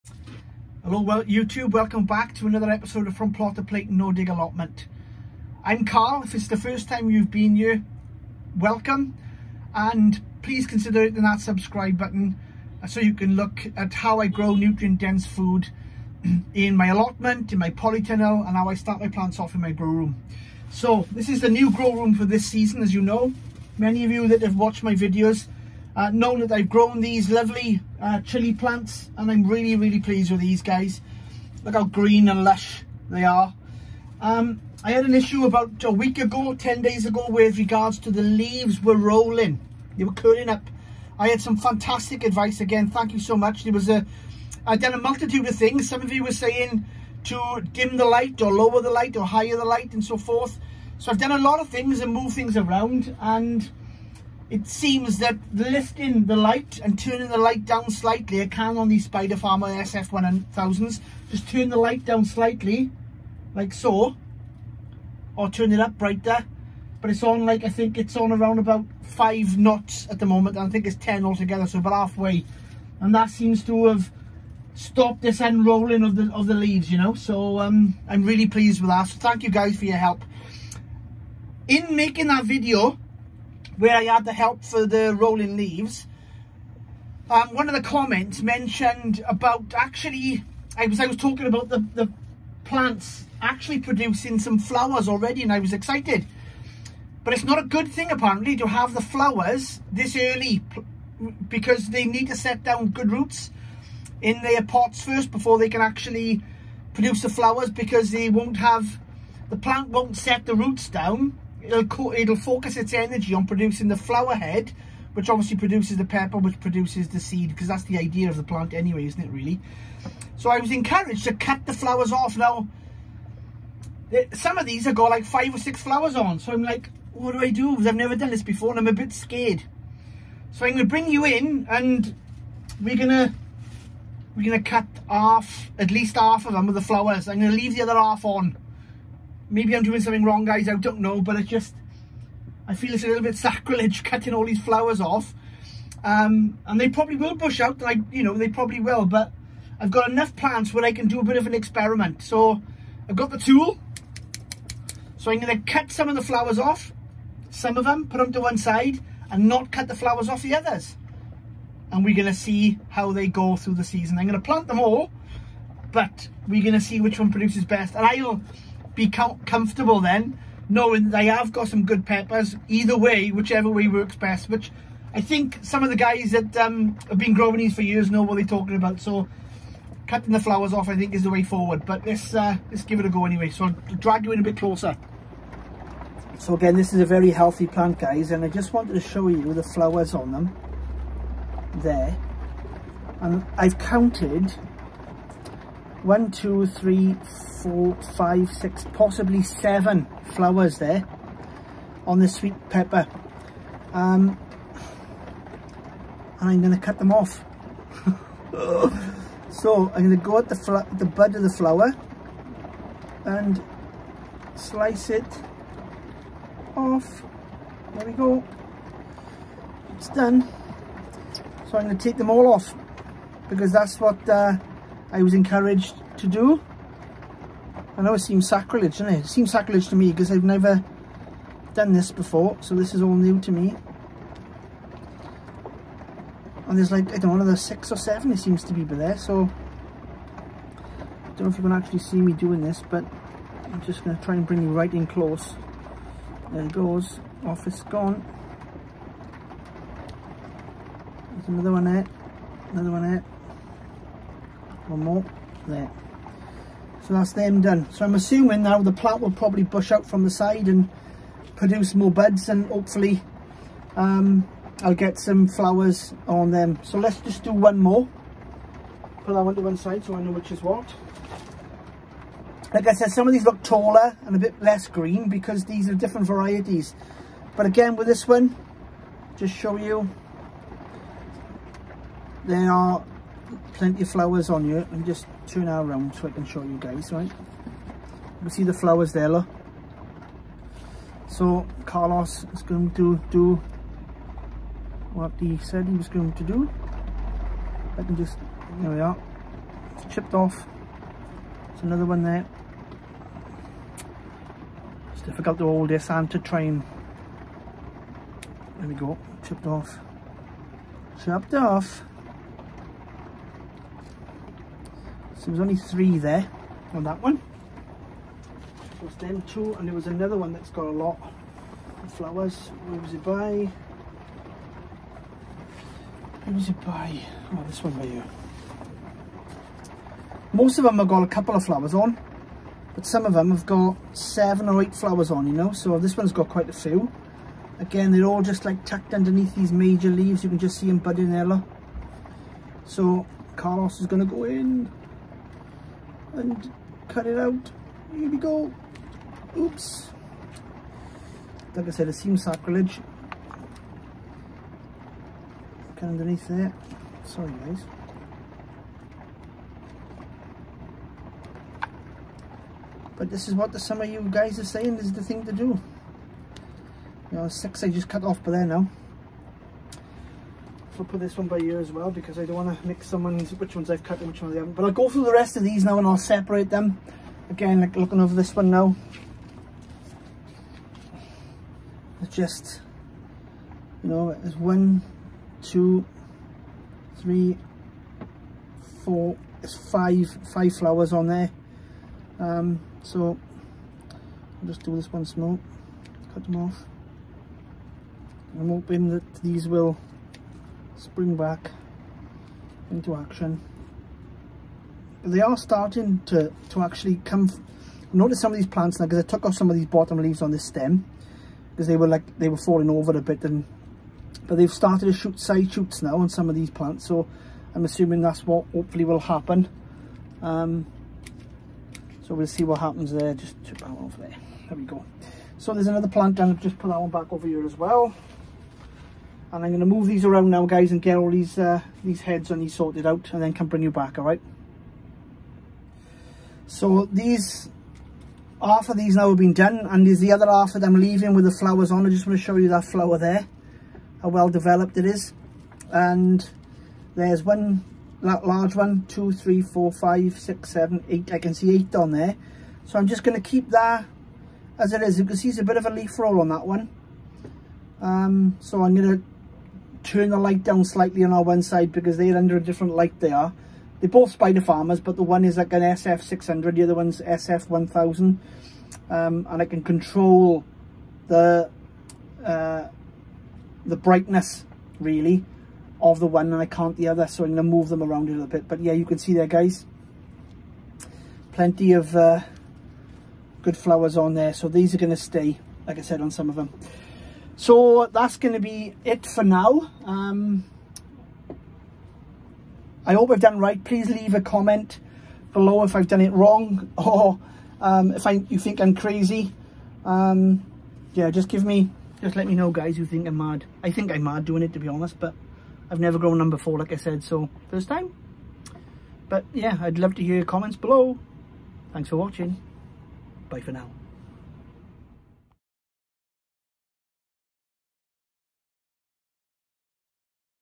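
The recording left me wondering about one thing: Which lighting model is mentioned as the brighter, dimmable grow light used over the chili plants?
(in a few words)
Spider Farmer SF1000.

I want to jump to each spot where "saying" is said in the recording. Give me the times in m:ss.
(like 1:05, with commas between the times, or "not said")
0:46, 6:04.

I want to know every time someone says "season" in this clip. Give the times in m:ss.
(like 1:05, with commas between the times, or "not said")
0:22, 2:43.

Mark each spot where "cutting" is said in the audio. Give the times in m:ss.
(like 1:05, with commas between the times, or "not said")
2:24, 3:00.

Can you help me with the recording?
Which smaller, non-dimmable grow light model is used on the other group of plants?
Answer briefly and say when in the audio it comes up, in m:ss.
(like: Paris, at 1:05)
SF600, at 7:45.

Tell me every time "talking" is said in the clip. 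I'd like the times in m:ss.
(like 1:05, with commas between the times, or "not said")
1:31, 2:58.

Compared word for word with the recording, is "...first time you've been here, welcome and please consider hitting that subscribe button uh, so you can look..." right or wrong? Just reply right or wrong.
right.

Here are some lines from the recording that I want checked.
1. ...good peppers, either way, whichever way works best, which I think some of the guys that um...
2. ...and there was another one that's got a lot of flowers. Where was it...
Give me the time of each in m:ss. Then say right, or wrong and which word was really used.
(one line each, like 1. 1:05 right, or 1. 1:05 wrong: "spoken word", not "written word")
1. 2:51 right
2. 5:19 right.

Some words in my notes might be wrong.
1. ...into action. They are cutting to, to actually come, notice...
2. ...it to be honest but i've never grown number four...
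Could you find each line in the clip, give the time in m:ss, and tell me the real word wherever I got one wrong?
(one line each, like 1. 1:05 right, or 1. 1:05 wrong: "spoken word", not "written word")
1. 6:42 wrong: "starting", not "cutting"
2. 8:24 right.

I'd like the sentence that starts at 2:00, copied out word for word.
So I was encouraged to cut the flowers off.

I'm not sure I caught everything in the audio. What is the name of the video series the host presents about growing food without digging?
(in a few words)
From Plot to Plate.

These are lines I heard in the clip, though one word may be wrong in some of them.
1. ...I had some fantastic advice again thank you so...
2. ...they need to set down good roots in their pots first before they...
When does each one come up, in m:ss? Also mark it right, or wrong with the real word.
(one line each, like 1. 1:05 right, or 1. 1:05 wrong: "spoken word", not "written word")
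1. 0:41 right
2. 1:41 right.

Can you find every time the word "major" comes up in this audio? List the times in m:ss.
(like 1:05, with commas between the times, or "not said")
5:39.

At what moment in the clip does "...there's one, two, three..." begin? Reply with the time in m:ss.
6:24.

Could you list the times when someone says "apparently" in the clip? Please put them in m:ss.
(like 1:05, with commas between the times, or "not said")
1:38.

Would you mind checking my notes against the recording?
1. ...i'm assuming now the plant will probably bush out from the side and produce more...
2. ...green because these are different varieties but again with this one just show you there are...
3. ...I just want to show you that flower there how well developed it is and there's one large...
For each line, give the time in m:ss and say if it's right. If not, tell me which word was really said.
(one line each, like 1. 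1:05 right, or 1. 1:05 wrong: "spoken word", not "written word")
1. 4:18 right
2. 4:34 right
3. 7:22 right.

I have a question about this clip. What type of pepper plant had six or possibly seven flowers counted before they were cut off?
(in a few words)
sweet pepper.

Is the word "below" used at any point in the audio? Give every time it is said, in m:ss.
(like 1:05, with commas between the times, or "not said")
8:15, 8:30.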